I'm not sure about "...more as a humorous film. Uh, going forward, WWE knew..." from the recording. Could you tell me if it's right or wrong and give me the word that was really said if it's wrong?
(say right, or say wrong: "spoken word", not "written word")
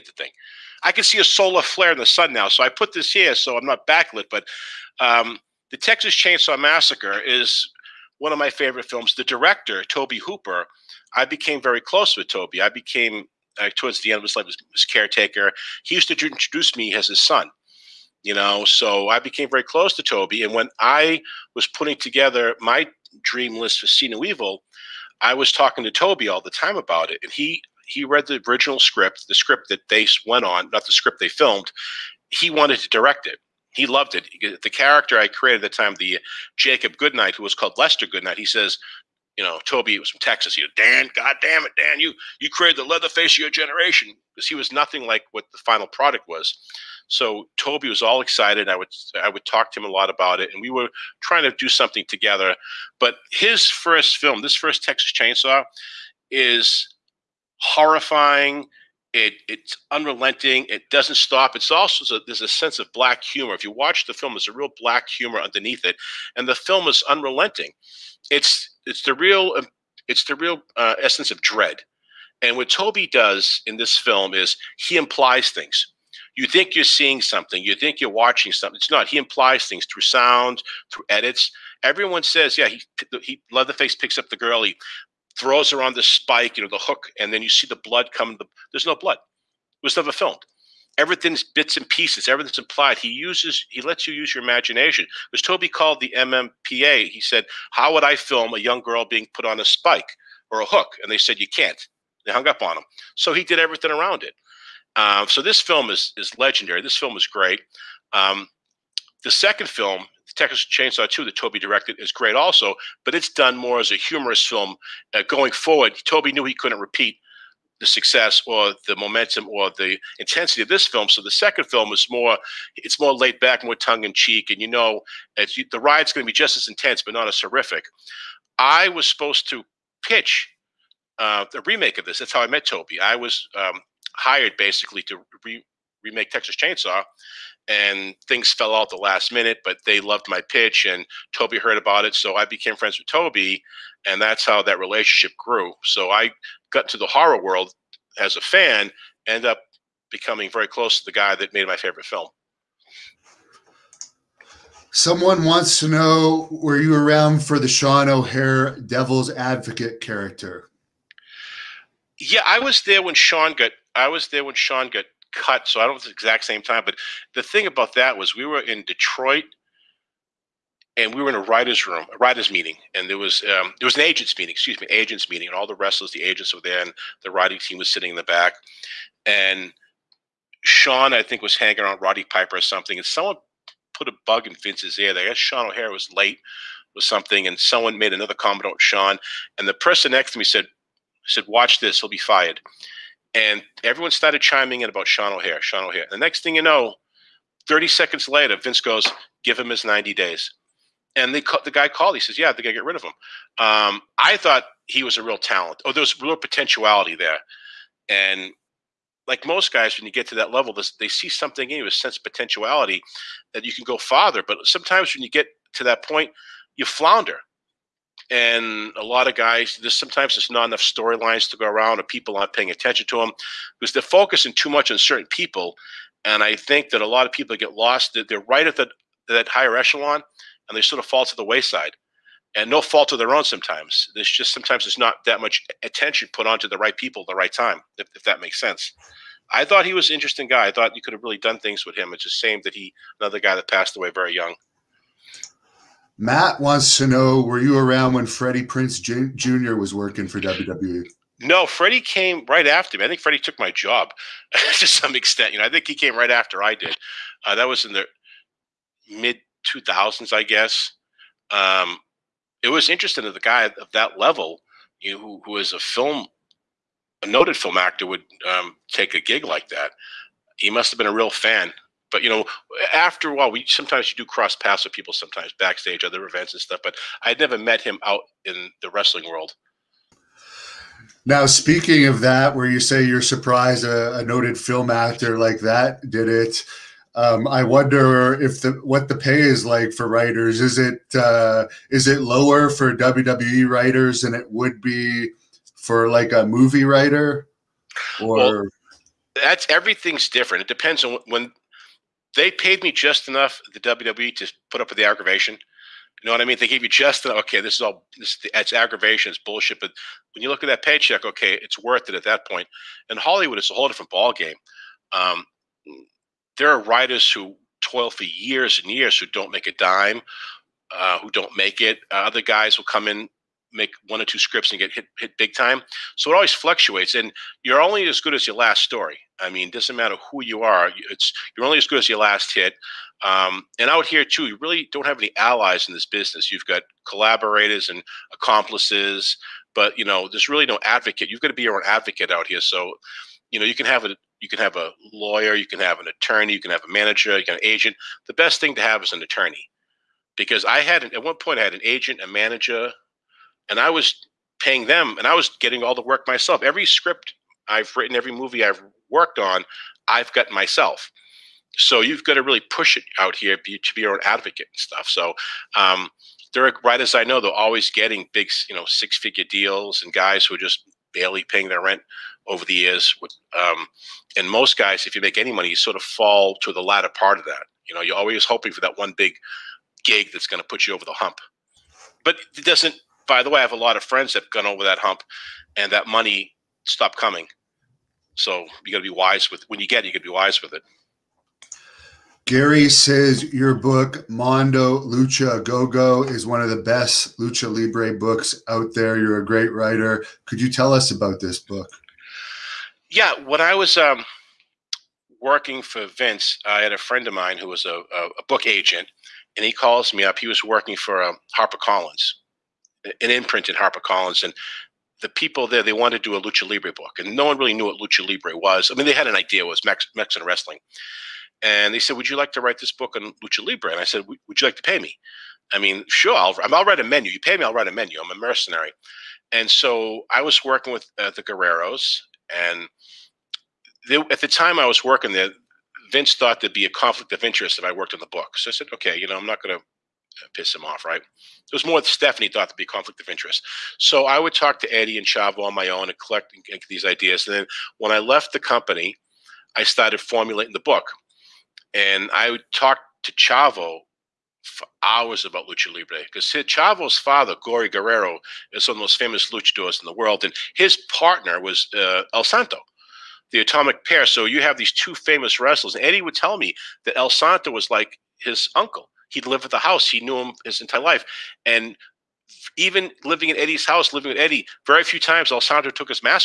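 wrong: "Toby", not "WWE".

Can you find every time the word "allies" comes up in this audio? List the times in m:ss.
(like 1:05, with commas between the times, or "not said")
5:35.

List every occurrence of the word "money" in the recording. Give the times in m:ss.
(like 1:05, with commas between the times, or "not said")
6:15, 6:26.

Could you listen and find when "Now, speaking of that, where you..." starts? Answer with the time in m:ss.
4:41.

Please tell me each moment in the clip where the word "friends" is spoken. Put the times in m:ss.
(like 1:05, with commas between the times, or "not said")
2:22, 6:24, 6:46.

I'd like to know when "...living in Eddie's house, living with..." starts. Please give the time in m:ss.
7:53.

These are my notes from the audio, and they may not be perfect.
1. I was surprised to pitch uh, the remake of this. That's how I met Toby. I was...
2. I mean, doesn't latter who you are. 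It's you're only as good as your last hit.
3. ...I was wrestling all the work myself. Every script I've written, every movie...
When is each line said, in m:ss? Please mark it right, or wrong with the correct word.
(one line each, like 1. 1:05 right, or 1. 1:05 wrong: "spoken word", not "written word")
1. 2:08 wrong: "supposed", not "surprised"
2. 5:29 wrong: "matter", not "latter"
3. 5:55 wrong: "getting", not "wrestling".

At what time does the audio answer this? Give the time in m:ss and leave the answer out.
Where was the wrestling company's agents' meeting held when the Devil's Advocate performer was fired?
2:48.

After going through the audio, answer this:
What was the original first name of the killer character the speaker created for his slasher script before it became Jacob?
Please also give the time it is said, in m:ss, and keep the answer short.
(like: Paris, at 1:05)
Lester, at 0:37.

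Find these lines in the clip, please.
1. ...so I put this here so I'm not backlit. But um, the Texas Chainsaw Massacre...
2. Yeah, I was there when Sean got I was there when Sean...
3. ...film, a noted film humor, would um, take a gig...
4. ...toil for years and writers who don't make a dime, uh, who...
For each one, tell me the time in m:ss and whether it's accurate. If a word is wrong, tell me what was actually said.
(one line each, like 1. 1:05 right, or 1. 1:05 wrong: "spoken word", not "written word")
1. 0:02 right
2. 2:42 right
3. 4:25 wrong: "actor", not "humor"
4. 5:17 wrong: "years", not "writers".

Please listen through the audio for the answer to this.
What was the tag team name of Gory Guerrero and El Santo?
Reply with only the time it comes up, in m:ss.
7:43.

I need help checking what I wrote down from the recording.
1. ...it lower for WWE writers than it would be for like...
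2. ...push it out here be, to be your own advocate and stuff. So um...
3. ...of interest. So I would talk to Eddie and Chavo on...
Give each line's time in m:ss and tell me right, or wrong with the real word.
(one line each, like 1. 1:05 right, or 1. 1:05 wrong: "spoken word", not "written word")
1. 4:52 right
2. 6:02 right
3. 7:23 right.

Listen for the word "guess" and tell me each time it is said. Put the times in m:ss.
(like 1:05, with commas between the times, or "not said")
3:05, 4:20.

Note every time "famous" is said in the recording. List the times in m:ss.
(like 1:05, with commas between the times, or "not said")
7:39, 7:45.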